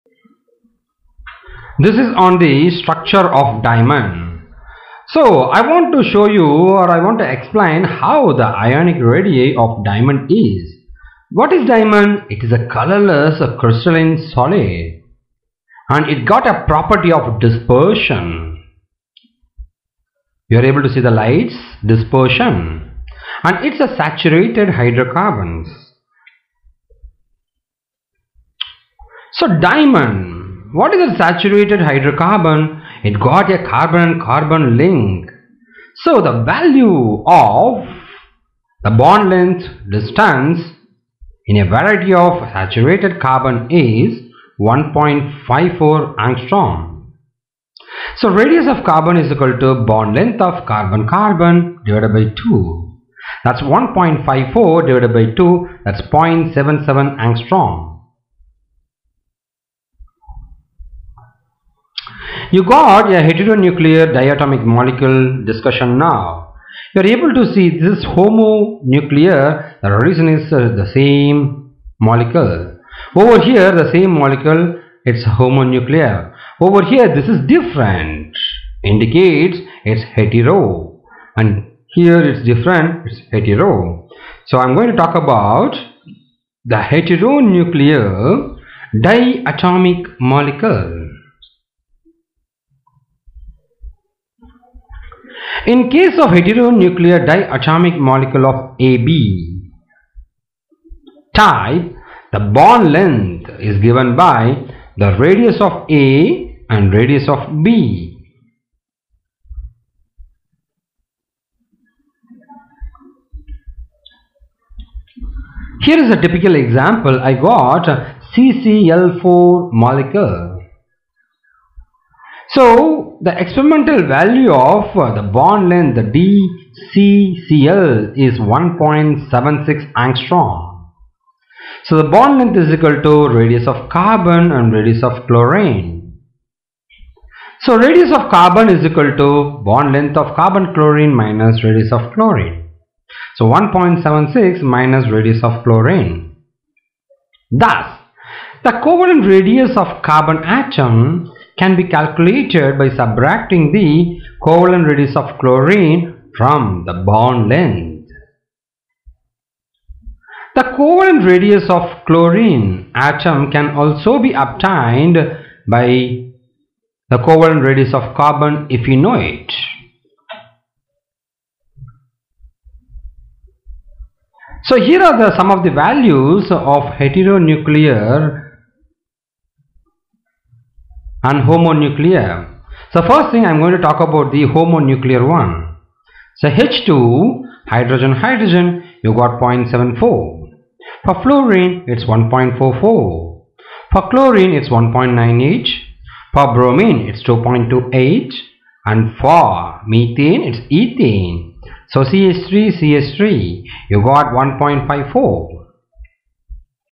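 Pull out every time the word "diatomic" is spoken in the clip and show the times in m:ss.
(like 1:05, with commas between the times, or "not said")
1:04, 1:28, 1:37.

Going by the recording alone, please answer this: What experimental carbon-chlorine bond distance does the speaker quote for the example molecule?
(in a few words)
1.76 angstrom.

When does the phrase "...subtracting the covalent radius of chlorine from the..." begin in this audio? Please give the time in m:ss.
2:32.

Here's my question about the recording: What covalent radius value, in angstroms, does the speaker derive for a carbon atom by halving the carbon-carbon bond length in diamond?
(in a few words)
0.77 angstrom.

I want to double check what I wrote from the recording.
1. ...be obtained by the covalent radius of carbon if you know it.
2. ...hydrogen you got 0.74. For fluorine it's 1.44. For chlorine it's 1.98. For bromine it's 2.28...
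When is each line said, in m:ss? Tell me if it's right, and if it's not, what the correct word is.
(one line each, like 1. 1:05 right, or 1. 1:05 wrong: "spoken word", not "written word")
1. 2:44 right
2. 3:08 right.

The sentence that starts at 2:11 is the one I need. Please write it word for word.
So the bond length is equal to radius of carbon and radius of chlorine.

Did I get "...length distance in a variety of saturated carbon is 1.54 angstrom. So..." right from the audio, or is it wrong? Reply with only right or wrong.
right.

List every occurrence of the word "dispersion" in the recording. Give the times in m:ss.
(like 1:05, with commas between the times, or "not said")
0:17, 0:21.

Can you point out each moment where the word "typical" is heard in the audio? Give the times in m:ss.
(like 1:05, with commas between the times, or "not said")
1:56.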